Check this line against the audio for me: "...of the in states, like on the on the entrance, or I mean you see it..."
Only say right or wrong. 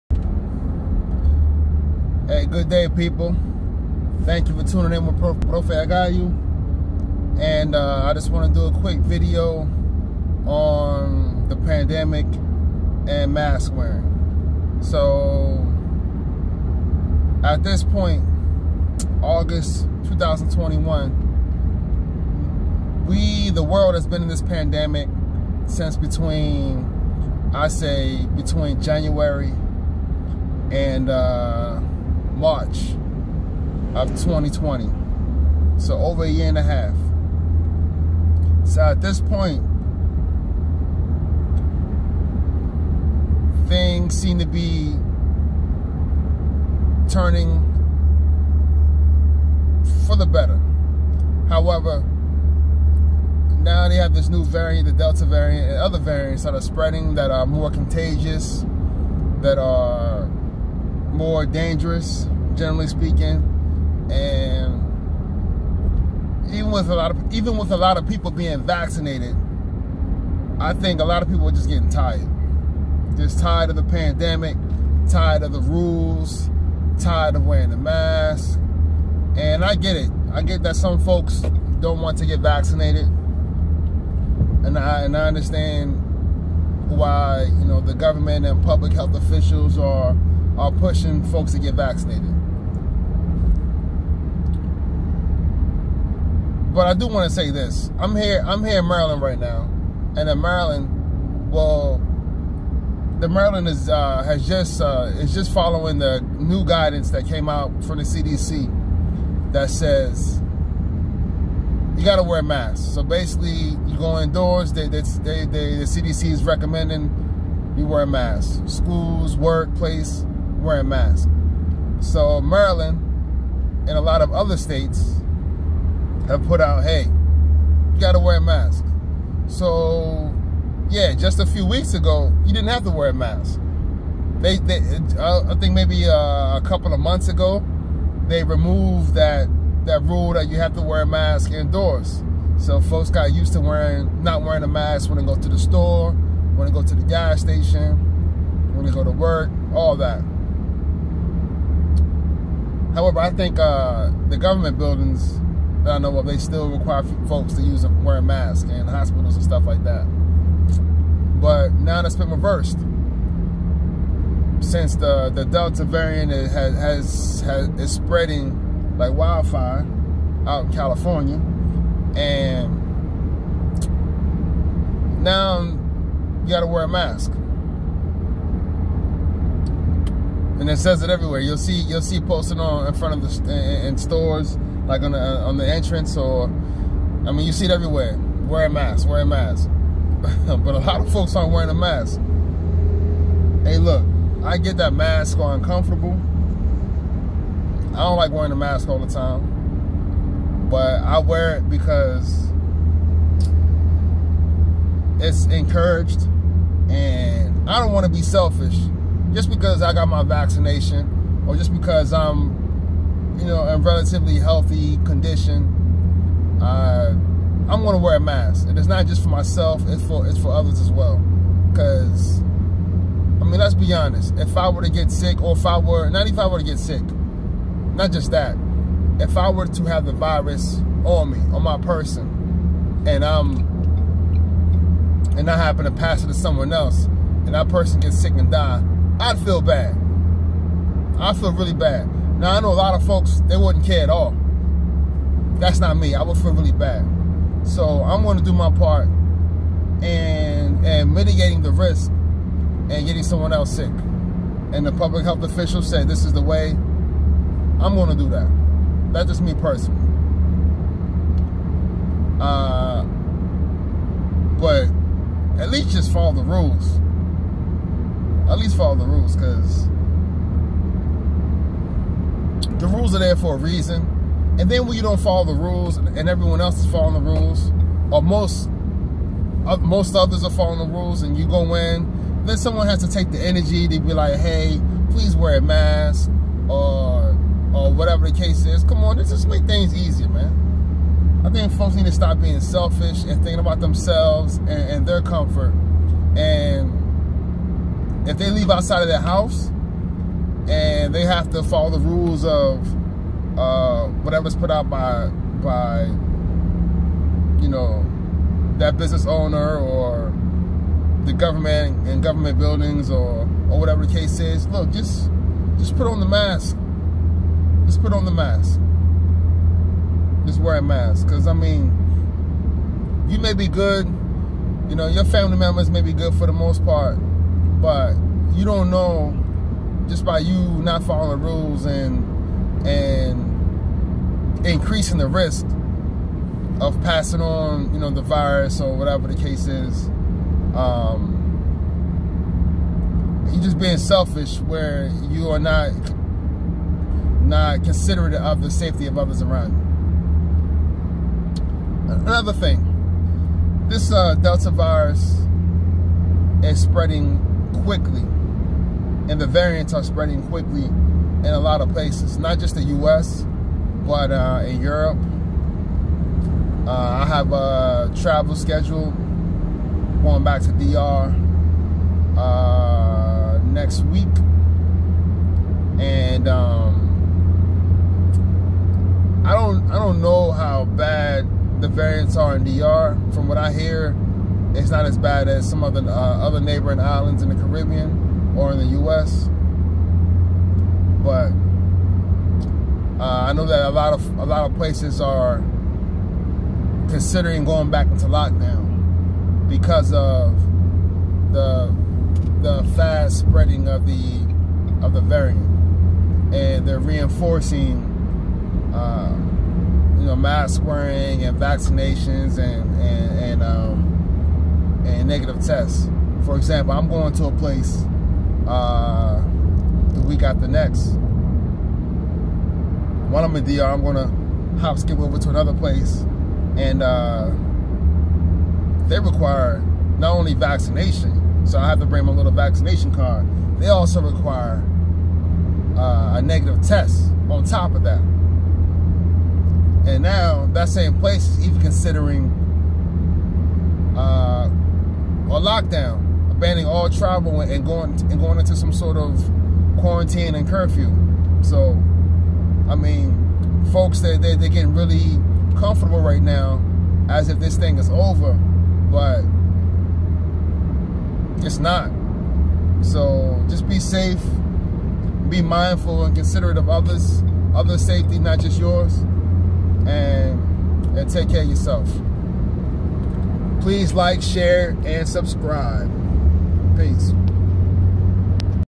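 wrong.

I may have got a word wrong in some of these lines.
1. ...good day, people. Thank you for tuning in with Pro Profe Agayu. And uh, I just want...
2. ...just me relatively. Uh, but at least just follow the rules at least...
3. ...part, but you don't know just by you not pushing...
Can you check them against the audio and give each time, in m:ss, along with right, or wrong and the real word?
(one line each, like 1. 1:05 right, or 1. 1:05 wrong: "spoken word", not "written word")
1. 0:02 right
2. 4:19 wrong: "personally", not "relatively"
3. 5:26 wrong: "following", not "pushing".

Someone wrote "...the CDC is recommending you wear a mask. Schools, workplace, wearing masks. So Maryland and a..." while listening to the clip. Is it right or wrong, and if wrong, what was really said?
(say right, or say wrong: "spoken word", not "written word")
right.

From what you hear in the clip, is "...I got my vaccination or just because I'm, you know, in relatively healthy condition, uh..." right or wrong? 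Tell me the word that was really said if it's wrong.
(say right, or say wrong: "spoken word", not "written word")
right.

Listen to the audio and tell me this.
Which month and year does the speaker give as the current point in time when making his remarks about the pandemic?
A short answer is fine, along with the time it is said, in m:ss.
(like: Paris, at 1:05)
August 2021, at 0:19.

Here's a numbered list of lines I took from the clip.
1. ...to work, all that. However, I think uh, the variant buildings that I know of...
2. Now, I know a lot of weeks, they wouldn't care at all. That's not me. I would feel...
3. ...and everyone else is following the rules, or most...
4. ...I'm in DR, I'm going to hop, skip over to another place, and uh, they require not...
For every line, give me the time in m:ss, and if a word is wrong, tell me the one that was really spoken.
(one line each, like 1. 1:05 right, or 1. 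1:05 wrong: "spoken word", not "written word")
1. 2:29 wrong: "government", not "variant"
2. 4:02 wrong: "folks", not "weeks"
3. 4:35 right
4. 7:03 right.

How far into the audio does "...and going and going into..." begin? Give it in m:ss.
7:27.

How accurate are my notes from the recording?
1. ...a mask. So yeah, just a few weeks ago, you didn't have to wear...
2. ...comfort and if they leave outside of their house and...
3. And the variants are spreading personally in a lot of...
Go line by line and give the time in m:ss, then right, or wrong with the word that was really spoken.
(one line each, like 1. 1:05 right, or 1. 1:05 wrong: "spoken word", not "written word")
1. 2:08 right
2. 4:55 right
3. 5:59 wrong: "quickly", not "personally".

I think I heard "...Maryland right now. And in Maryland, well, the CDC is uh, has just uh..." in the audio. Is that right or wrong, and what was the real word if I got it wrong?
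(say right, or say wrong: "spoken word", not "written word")
wrong: "Maryland", not "CDC".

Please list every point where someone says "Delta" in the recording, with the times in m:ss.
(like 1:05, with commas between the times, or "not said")
0:54, 2:45, 5:54.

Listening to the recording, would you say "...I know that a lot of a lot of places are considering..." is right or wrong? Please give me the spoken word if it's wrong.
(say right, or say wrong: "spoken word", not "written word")
right.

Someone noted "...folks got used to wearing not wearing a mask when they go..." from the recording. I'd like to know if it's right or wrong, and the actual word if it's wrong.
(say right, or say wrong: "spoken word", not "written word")
right.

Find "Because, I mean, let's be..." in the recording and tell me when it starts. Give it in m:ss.
3:41.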